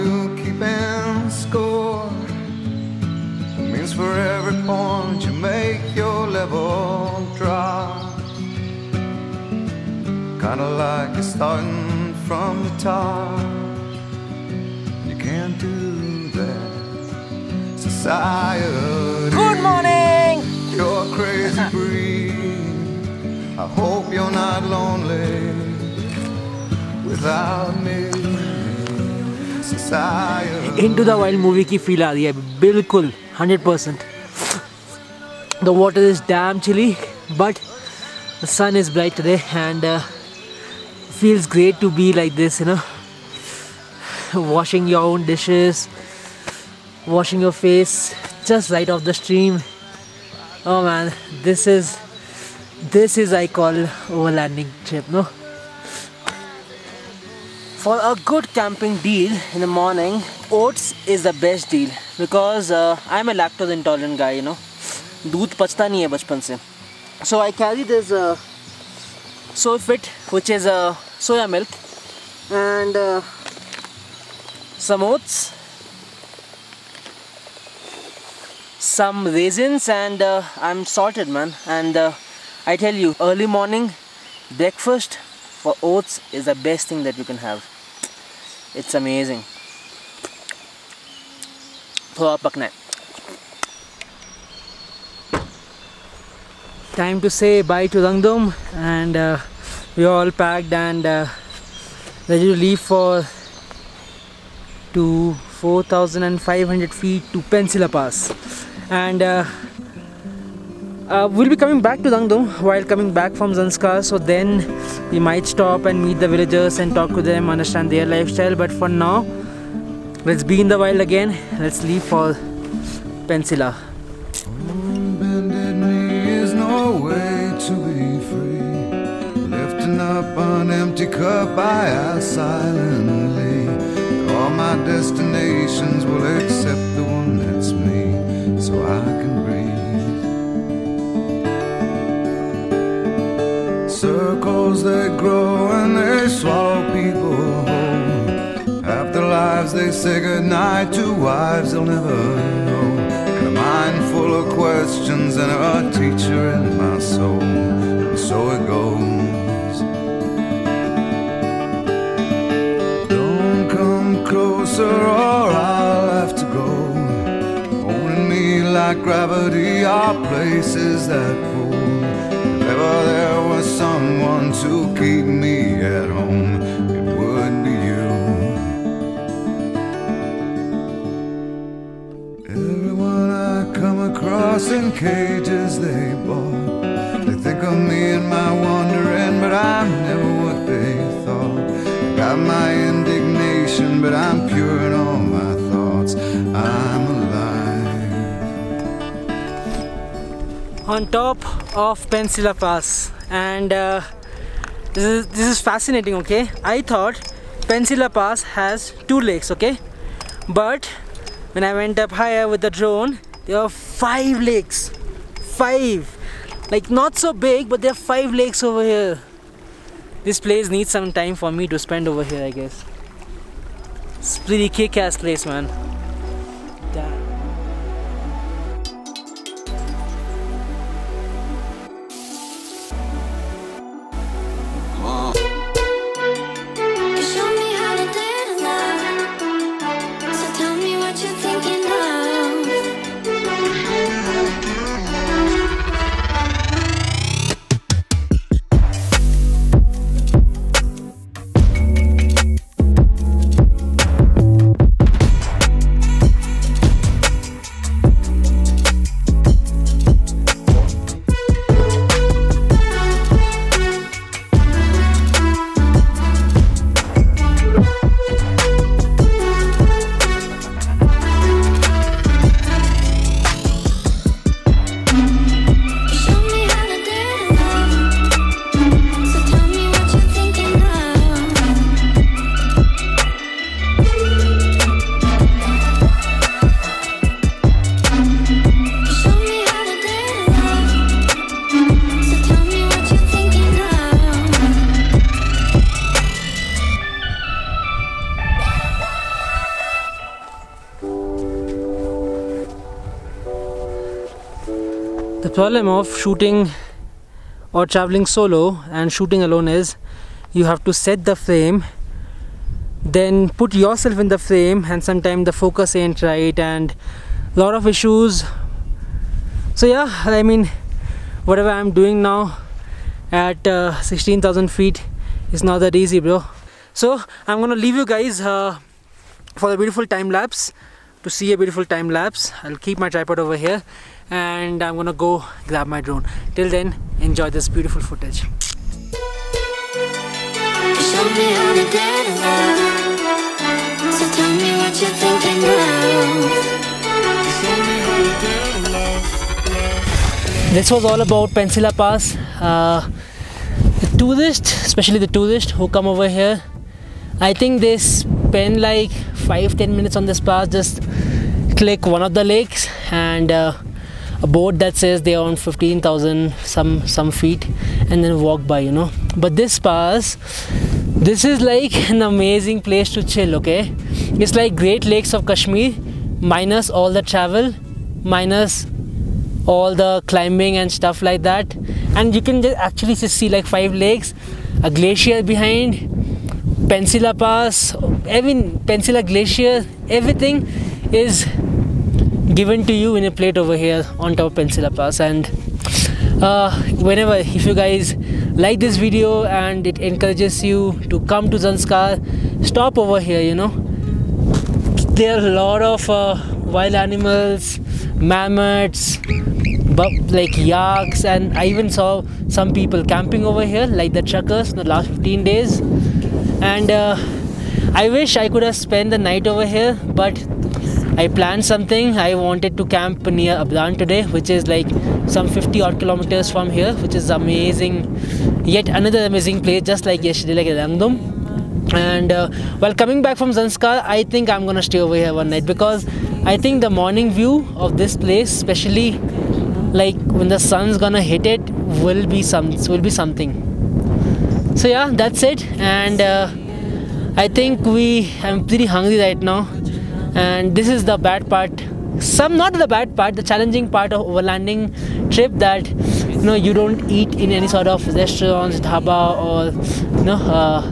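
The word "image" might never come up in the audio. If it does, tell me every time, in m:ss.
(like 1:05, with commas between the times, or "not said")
not said.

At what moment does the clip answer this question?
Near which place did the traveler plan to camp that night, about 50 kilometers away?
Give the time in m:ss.
7:03.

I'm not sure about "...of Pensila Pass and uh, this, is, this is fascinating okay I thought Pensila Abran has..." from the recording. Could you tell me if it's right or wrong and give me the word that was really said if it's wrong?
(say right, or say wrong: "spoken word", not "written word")
wrong: "Pass", not "Abran".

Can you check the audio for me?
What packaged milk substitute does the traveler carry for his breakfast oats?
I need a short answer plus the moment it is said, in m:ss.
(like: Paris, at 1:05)
soya milk, at 1:11.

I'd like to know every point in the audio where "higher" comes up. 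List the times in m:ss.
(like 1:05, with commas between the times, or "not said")
3:32.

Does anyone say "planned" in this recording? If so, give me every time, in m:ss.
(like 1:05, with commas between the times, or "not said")
7:01.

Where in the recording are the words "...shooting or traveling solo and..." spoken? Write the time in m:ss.
5:06.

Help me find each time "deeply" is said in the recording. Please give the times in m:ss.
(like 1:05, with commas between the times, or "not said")
not said.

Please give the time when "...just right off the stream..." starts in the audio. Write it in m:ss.
0:48.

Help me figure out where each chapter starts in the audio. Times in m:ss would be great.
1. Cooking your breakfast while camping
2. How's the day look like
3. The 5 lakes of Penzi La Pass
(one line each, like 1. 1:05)
1. 0:54
2. 1:39
3. 3:29.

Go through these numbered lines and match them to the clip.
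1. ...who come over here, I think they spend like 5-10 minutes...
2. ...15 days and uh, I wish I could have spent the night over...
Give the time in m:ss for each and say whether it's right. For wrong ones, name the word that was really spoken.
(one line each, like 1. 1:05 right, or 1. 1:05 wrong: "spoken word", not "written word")
1. 5:55 right
2. 6:55 right.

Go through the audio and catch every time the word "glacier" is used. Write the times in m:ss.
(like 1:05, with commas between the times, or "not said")
6:24, 6:29.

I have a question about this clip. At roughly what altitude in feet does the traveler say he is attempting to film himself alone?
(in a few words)
16,000 feet.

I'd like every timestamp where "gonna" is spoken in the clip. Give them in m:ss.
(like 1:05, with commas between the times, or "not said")
5:27, 5:34, 7:14, 7:20.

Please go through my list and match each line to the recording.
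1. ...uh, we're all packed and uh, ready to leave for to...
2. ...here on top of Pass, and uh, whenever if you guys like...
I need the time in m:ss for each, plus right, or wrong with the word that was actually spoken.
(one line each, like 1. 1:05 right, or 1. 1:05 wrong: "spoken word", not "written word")
1. 1:39 right
2. 6:33 right.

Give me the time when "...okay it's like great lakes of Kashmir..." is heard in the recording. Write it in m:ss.
6:13.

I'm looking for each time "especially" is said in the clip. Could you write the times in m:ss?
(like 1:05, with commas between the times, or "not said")
5:54, 7:18.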